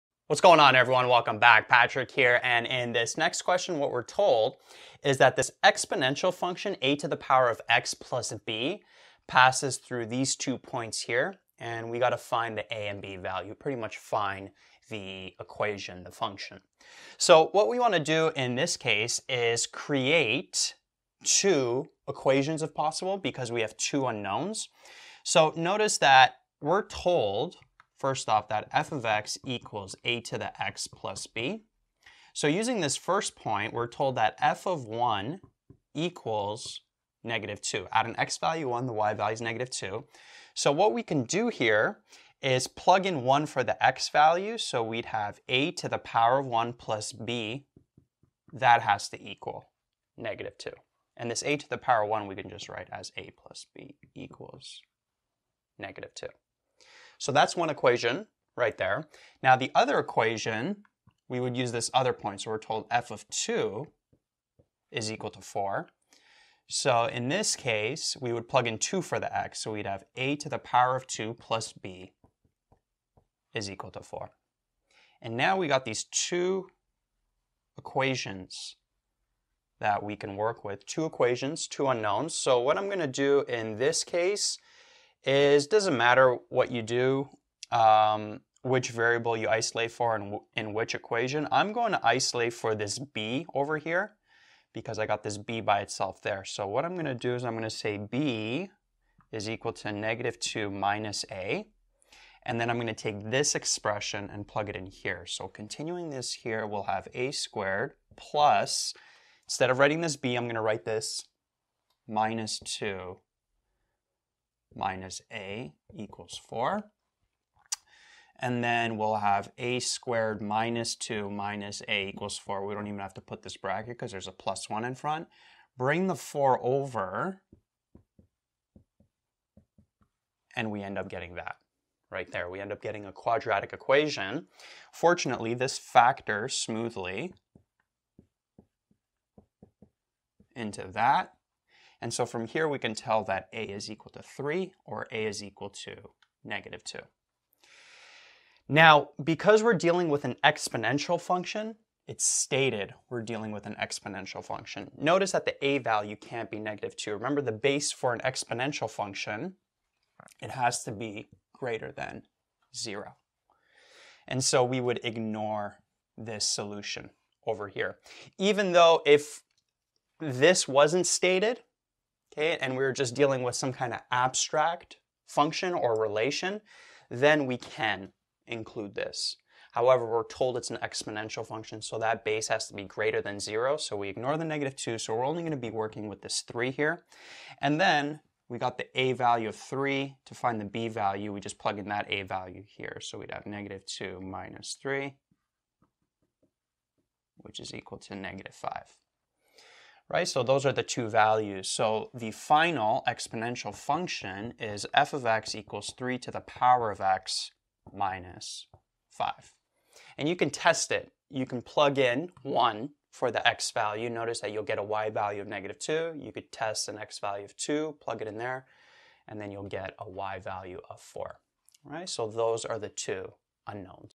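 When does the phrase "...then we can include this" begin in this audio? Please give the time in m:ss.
2:57.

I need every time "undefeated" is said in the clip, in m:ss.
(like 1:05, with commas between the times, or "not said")
not said.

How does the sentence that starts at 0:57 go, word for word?
So that's one equation right there.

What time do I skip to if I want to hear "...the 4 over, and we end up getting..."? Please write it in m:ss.
2:06.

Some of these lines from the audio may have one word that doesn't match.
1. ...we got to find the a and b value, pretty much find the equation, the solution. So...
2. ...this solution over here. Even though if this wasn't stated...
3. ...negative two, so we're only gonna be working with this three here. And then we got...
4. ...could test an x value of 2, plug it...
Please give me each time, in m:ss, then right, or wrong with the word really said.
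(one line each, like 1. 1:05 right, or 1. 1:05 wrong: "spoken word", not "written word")
1. 0:11 wrong: "function", not "solution"
2. 2:46 right
3. 3:04 right
4. 3:36 right.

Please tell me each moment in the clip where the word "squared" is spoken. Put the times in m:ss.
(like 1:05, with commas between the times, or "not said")
1:47, 1:59.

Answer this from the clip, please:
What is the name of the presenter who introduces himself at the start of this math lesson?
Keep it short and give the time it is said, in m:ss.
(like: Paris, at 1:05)
Patrick, at 0:01.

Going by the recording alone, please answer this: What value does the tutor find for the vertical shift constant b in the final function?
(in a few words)
-5.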